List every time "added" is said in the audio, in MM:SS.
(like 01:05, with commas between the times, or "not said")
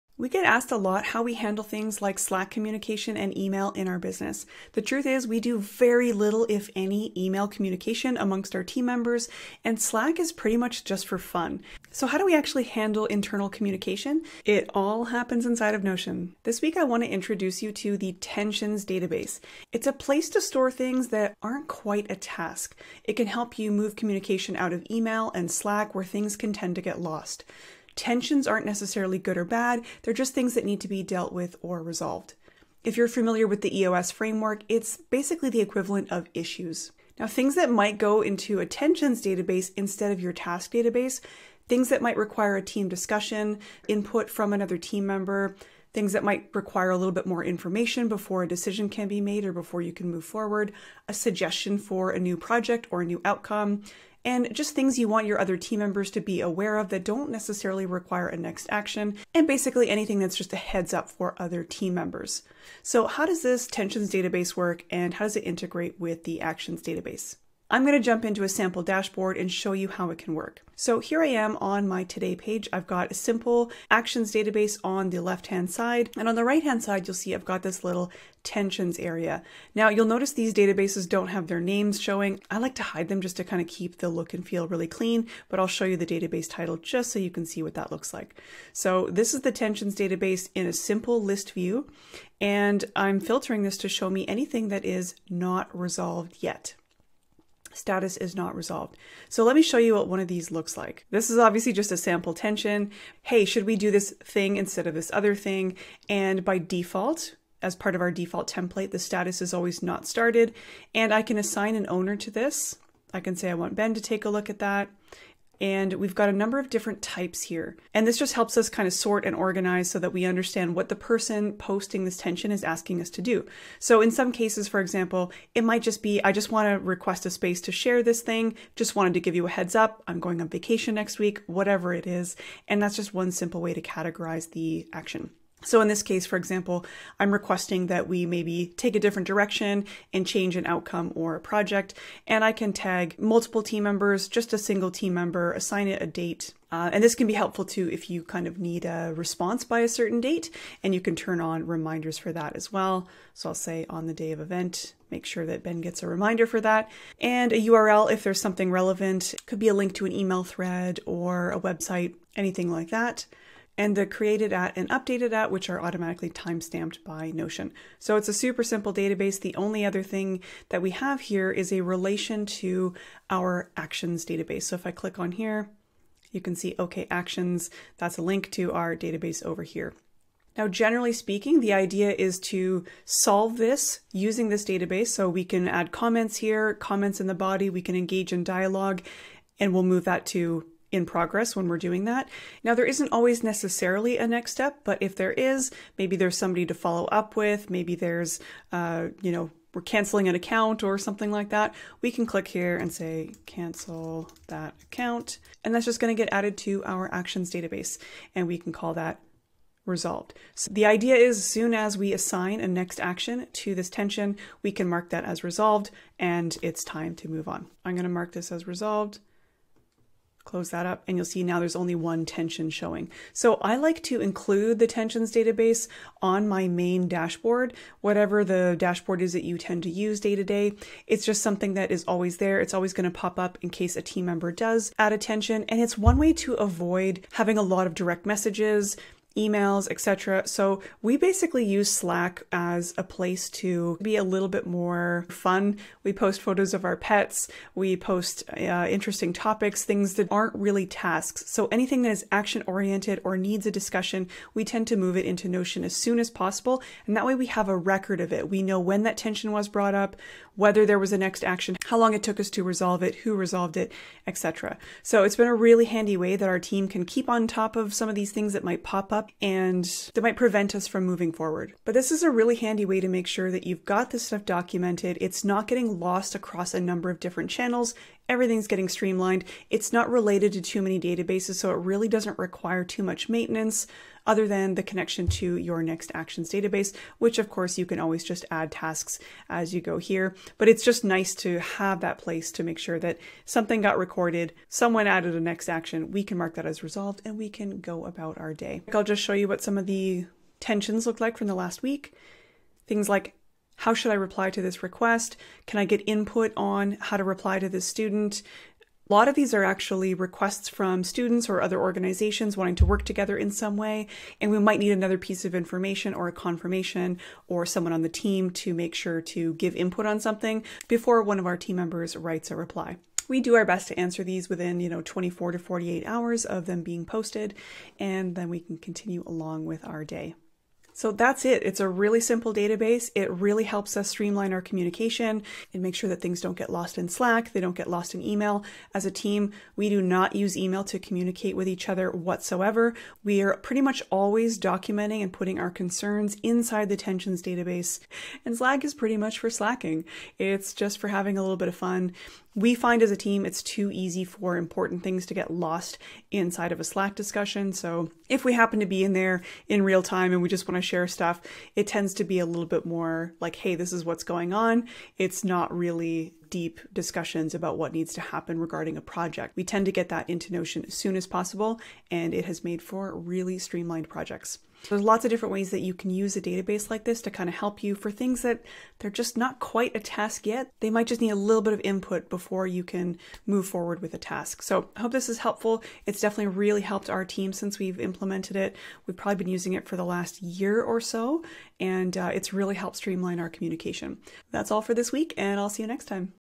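03:26, 04:55.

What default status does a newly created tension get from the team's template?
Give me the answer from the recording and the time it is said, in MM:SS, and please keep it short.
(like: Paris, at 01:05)
Not started, at 01:49.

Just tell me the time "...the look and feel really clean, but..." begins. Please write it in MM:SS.
01:23.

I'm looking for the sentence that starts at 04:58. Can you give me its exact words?
I'll just show you what some of the tensions look like from the last week.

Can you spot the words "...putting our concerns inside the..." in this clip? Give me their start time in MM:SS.
05:45.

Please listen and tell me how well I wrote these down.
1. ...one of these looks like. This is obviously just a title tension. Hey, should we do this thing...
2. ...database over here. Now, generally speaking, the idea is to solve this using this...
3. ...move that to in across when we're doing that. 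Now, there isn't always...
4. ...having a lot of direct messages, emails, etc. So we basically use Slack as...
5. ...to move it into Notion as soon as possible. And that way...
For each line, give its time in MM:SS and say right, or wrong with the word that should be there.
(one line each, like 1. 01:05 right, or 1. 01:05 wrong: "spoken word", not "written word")
1. 01:40 wrong: "sample", not "title"
2. 02:58 right
3. 03:09 wrong: "progress", not "across"
4. 03:57 right
5. 04:14 right.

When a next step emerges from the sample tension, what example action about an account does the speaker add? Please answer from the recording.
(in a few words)
Cancel that account.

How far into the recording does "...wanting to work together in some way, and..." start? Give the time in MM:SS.
05:12.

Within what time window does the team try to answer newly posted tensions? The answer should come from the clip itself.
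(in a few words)
24 to 48 hours.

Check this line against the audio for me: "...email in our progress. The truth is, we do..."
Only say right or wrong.
wrong.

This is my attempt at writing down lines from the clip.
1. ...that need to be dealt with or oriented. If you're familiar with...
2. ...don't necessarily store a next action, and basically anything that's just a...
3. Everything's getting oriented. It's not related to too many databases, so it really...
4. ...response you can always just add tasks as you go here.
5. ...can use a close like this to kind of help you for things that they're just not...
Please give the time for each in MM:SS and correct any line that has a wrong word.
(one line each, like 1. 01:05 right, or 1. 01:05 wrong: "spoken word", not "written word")
1. 00:30 wrong: "resolved", not "oriented"
2. 00:57 wrong: "require", not "store"
3. 04:38 wrong: "streamlined", not "oriented"
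4. 04:47 wrong: "course", not "response"
5. 06:15 wrong: "database", not "close".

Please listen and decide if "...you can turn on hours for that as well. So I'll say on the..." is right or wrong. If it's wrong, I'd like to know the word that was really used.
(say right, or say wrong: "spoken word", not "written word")
wrong: "reminders", not "hours".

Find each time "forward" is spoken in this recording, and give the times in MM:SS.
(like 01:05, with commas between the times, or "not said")
00:50, 04:31, 06:23.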